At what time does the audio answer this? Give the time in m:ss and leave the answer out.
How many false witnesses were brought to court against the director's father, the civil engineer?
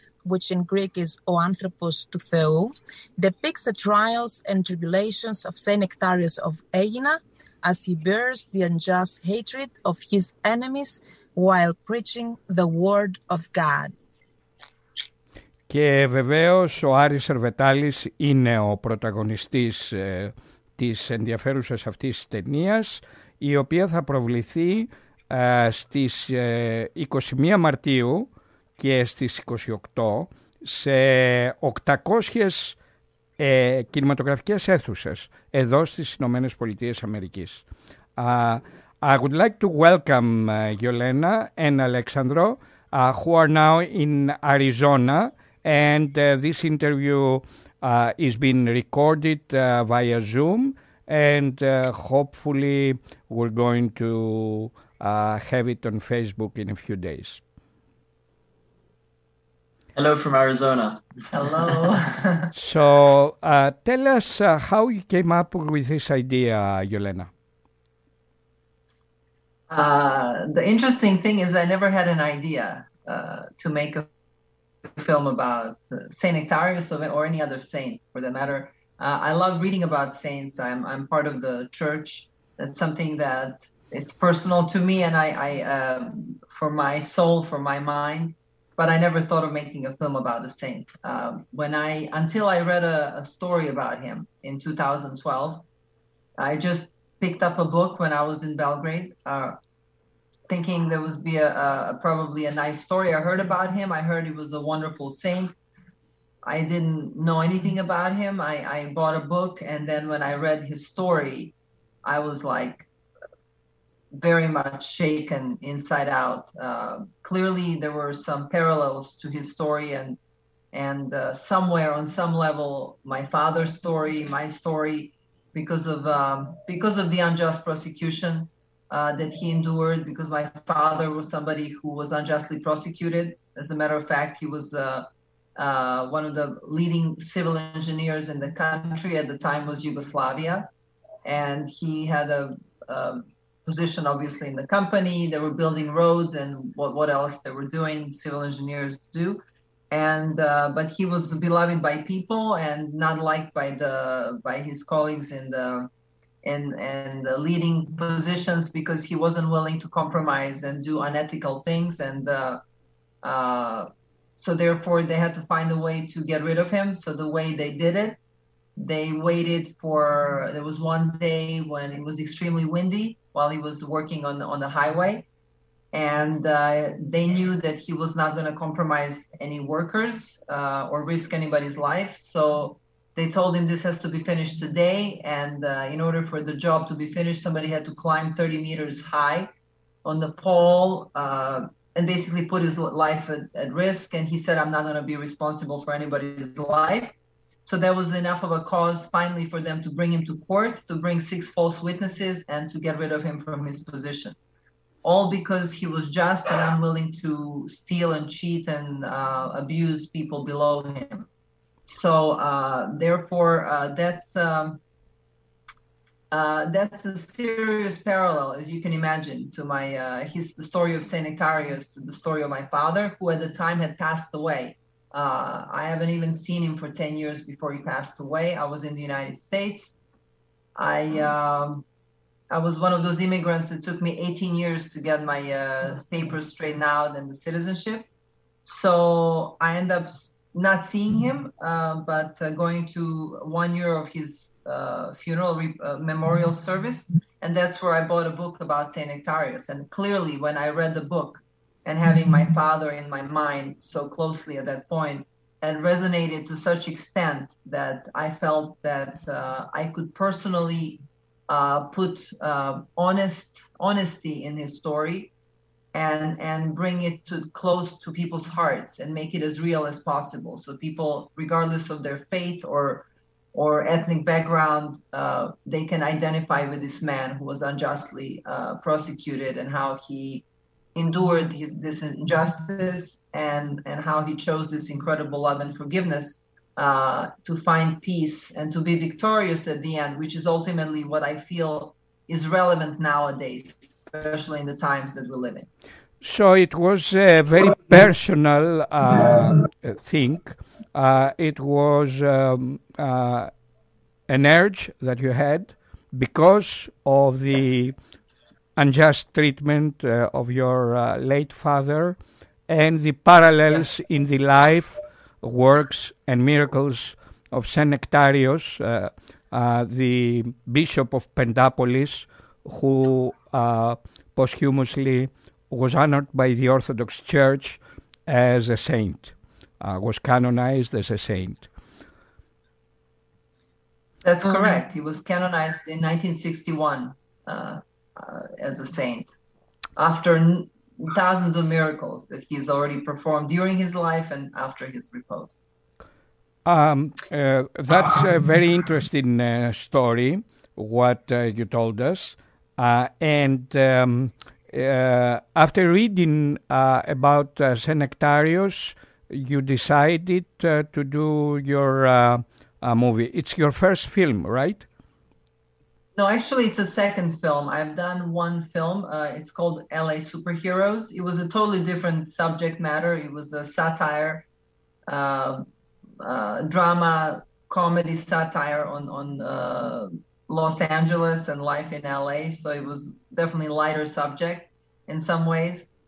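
3:21.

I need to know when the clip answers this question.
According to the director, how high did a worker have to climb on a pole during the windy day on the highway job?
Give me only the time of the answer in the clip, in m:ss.
3:08.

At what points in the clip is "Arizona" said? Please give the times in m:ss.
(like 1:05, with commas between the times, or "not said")
0:44, 1:00.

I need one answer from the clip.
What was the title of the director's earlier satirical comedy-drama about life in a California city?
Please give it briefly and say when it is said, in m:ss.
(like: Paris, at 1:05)
LA Superheroes, at 6:09.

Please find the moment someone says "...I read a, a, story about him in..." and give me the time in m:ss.
1:32.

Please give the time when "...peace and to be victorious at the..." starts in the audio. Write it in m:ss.
4:48.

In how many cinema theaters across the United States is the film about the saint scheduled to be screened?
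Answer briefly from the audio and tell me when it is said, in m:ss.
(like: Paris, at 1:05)
800, at 0:30.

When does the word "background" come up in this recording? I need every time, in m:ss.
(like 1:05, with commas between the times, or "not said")
4:34.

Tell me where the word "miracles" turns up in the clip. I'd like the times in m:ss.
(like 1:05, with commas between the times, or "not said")
5:16, 5:41.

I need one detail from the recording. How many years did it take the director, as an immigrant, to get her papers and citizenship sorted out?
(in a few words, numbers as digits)
18.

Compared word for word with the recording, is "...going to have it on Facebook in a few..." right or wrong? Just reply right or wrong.
right.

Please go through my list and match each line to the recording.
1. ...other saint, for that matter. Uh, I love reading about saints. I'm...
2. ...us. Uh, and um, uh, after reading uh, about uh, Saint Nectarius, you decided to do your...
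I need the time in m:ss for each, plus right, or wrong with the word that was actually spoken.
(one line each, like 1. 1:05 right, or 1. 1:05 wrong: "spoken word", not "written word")
1. 1:17 right
2. 5:52 right.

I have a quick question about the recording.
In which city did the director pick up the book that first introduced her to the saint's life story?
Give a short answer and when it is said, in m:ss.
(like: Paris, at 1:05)
Belgrade, at 1:38.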